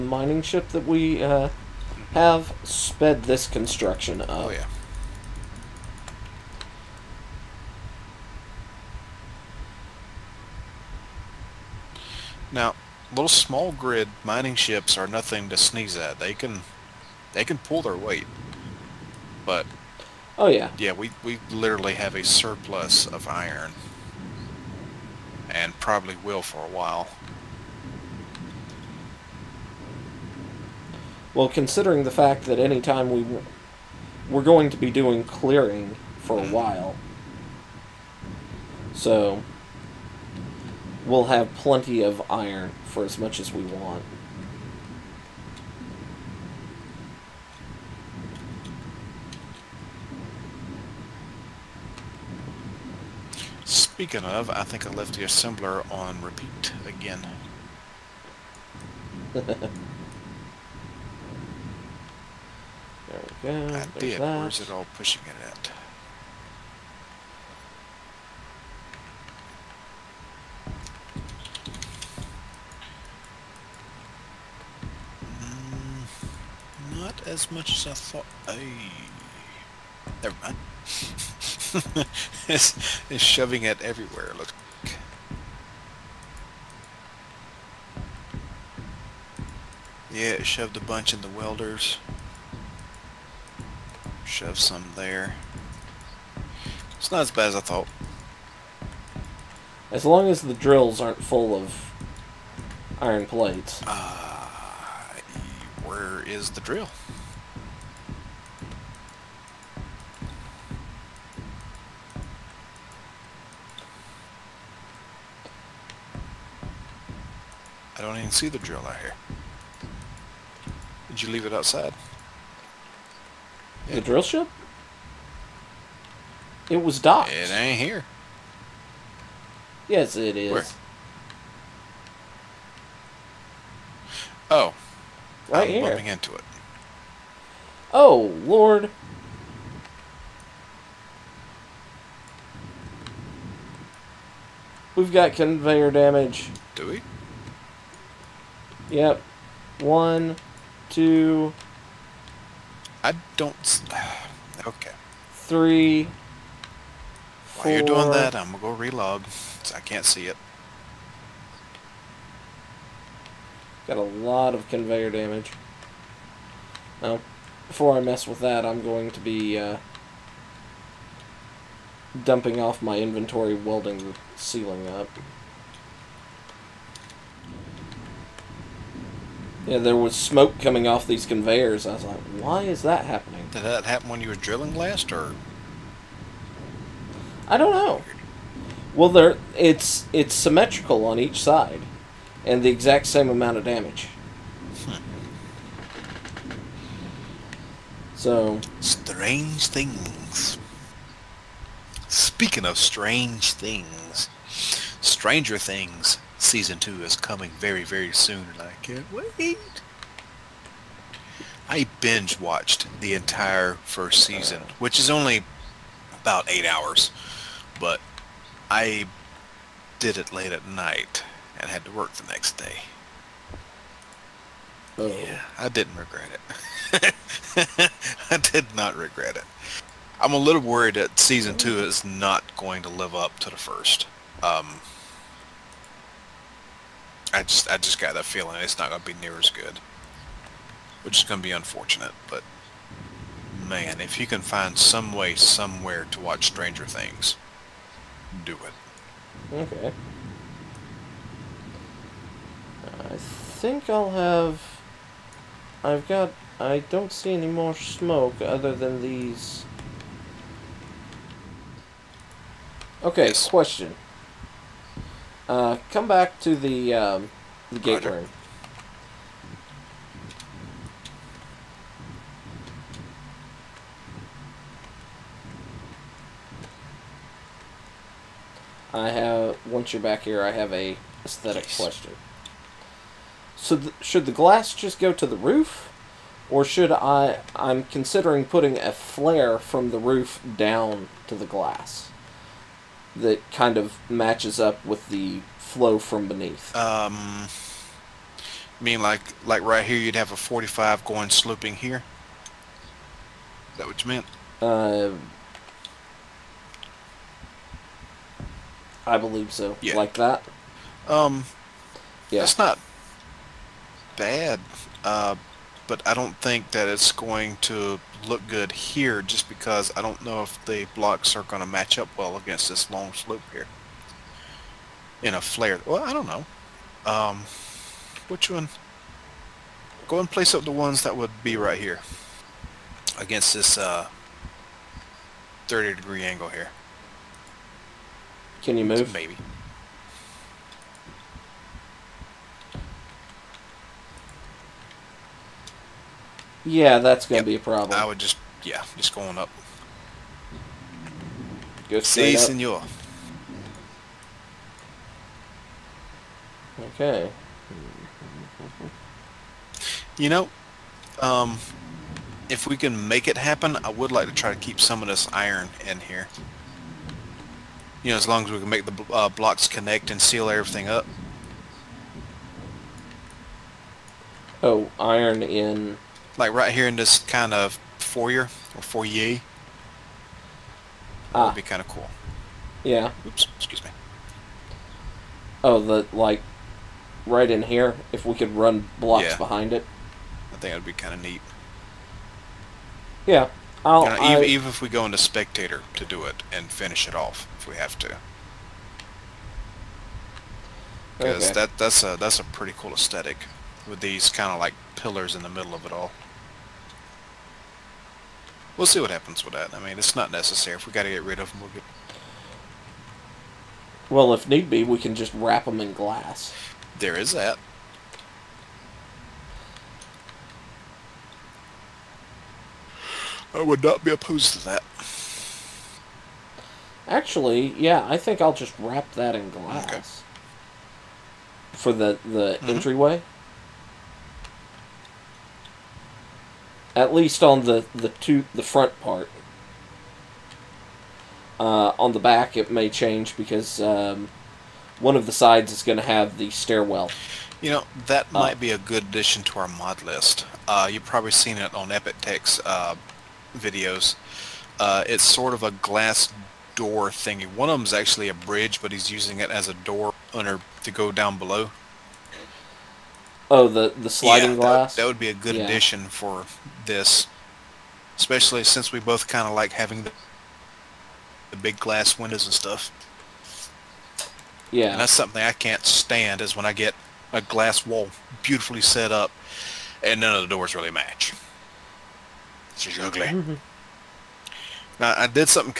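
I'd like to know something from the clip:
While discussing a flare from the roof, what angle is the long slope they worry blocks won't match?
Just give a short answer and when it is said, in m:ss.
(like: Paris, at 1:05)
30 degrees, at 5:35.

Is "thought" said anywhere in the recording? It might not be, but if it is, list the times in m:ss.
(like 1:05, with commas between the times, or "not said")
1:17, 1:37.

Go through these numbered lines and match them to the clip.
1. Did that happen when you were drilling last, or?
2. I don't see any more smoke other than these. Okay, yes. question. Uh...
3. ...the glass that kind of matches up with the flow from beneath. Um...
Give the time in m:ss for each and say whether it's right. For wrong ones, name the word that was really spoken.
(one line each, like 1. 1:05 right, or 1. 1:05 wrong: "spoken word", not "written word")
1. 3:03 right
2. 4:16 right
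3. 4:51 right.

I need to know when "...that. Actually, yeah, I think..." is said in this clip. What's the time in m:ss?
7:04.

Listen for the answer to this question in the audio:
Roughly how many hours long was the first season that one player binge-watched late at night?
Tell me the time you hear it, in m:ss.
3:36.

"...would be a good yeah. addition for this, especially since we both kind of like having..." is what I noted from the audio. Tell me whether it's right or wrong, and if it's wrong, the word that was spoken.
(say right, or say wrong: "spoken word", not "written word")
right.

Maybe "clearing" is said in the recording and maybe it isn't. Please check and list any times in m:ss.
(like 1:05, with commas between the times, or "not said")
0:35.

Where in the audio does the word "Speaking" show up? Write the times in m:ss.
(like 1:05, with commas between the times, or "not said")
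0:53, 3:22.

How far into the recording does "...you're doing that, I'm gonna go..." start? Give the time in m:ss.
2:37.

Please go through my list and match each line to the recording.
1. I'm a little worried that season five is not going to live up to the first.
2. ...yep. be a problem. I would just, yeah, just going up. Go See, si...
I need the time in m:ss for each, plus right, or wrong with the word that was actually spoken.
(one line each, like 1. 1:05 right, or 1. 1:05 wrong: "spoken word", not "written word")
1. 3:50 wrong: "two", not "five"
2. 5:47 right.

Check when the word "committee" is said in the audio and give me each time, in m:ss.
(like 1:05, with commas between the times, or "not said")
not said.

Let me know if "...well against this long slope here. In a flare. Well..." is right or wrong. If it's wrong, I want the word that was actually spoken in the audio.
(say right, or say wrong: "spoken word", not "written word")
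right.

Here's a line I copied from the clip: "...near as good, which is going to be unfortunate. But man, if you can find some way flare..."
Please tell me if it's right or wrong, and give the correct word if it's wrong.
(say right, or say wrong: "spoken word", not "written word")
wrong: "somewhere", not "flare".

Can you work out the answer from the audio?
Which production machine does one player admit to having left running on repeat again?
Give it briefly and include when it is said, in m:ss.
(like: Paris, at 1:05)
assembler, at 0:55.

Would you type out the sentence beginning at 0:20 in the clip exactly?
Yeah, we we literally have a surplus of iron and probably will for a while.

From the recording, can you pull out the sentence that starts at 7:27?
You know, that uh, might be a good addition to our mod list.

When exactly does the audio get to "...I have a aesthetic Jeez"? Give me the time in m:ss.
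4:40.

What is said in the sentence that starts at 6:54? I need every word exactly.
Well, if need be, we can just wrap them in glass.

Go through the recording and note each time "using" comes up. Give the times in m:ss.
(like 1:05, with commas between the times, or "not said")
7:39.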